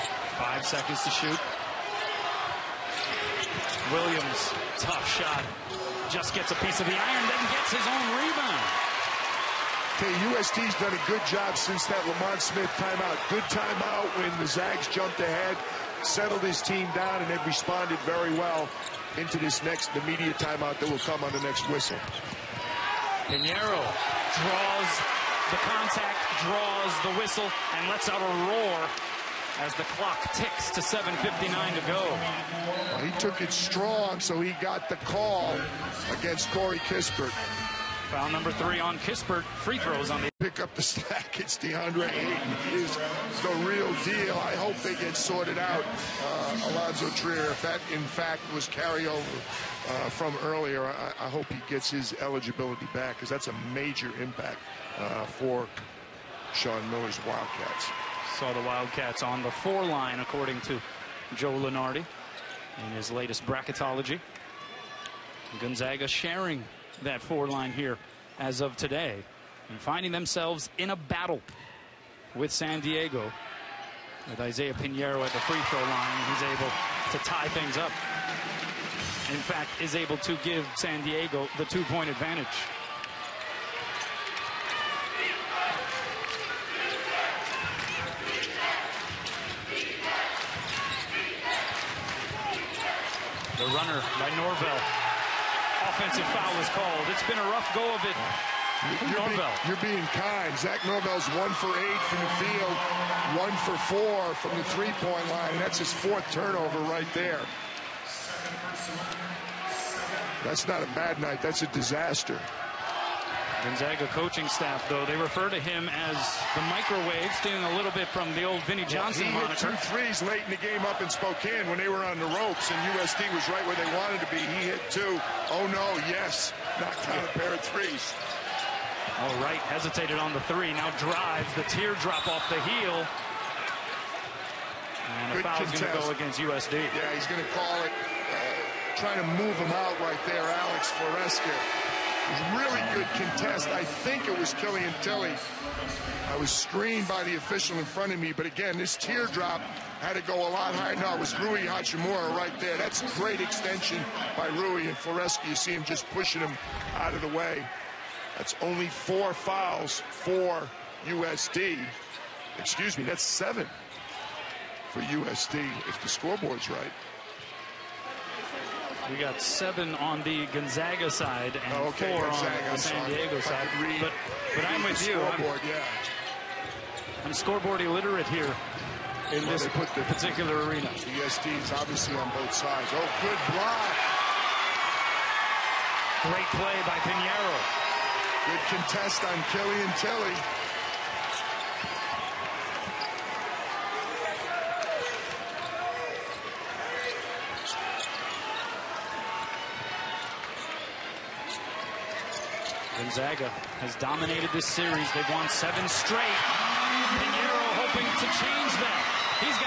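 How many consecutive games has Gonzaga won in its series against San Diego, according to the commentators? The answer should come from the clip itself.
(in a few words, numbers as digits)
7.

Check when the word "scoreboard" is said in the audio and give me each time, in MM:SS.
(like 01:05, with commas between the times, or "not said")
02:46, 02:57.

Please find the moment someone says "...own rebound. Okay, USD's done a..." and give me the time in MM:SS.
00:07.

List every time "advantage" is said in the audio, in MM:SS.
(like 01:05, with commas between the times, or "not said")
01:22.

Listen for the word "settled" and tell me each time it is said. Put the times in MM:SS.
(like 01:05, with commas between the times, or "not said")
00:16.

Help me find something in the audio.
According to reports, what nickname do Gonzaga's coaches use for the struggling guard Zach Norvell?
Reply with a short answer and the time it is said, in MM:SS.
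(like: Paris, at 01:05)
the microwave, at 01:56.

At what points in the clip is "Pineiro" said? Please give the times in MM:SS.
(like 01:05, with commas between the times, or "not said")
00:23, 01:14, 03:07, 03:26.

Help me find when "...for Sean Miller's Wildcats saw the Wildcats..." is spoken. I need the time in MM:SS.
00:55.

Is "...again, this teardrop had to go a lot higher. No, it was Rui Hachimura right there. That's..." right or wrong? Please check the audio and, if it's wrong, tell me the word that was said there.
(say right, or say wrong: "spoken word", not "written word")
right.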